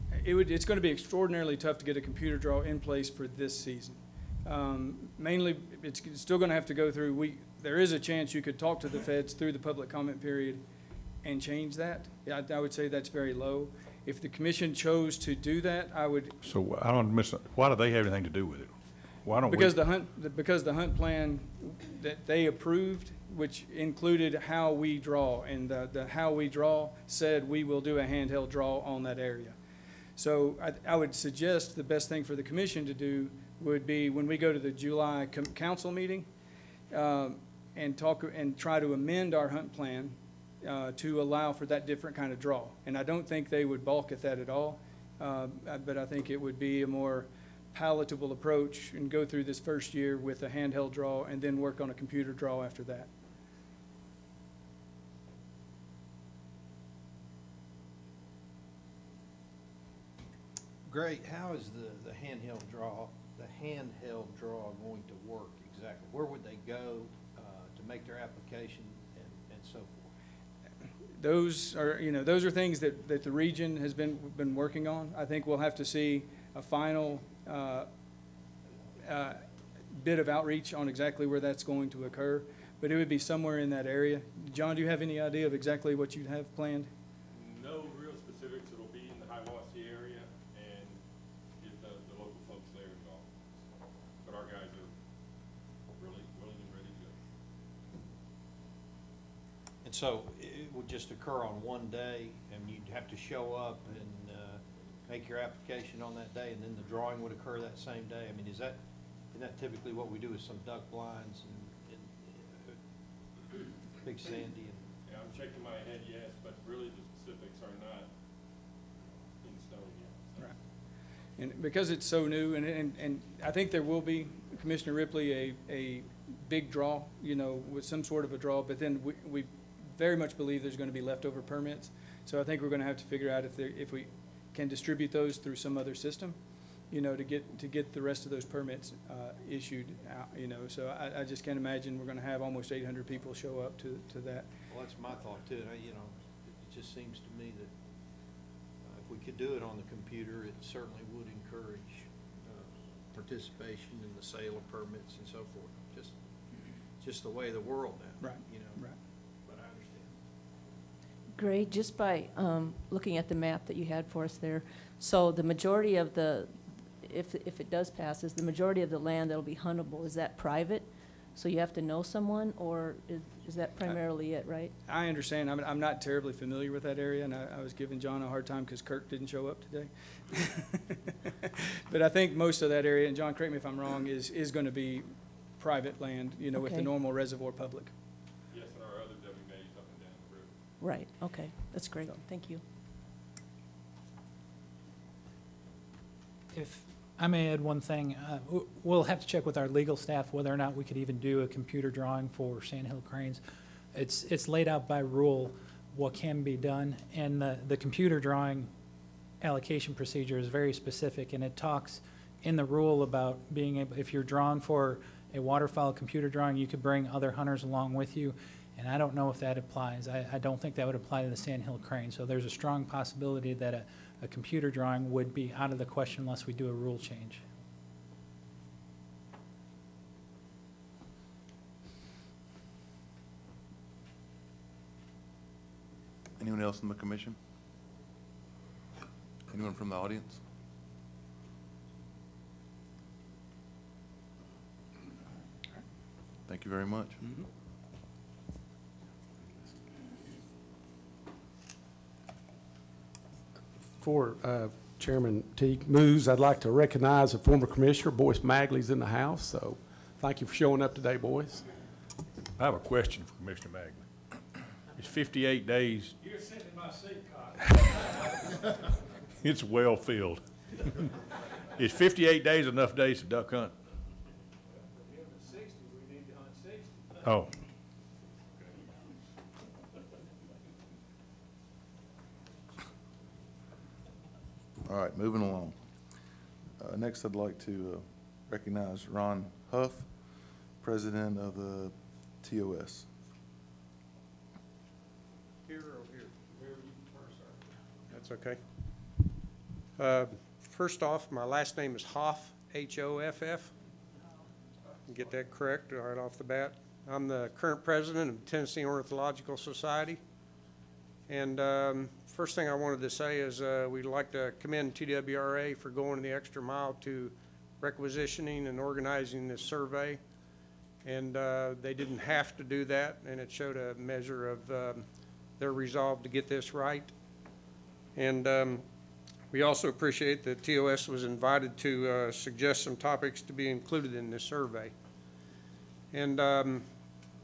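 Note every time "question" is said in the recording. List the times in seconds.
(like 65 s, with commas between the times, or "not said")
225 s, 262 s.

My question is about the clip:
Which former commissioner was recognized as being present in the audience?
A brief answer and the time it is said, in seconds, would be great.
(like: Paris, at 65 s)
Boyce Magley, at 258 s.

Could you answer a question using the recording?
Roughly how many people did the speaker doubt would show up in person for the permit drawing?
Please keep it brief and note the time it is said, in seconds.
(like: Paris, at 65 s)
800, at 142 s.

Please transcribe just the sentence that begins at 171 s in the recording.
So you have to know someone, or is, is that primarily it, right?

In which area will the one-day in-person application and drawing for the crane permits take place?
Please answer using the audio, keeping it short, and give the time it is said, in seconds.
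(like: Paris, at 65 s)
Hiwassee area, at 89 s.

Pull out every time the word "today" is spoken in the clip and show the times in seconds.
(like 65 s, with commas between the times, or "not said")
179 s, 260 s.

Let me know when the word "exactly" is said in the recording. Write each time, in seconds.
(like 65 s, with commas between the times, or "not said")
65 s, 80 s, 85 s.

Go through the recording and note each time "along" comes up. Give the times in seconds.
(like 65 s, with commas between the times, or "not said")
217 s, 285 s.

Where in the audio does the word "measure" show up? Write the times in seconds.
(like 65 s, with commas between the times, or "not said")
323 s.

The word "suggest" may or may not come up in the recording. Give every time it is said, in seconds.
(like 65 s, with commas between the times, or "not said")
31 s, 332 s.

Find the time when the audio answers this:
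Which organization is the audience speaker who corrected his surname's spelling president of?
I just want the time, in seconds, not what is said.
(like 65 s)
308 s.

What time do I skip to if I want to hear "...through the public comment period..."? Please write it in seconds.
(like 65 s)
9 s.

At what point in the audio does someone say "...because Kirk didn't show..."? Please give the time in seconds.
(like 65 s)
178 s.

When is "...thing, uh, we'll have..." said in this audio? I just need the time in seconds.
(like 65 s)
197 s.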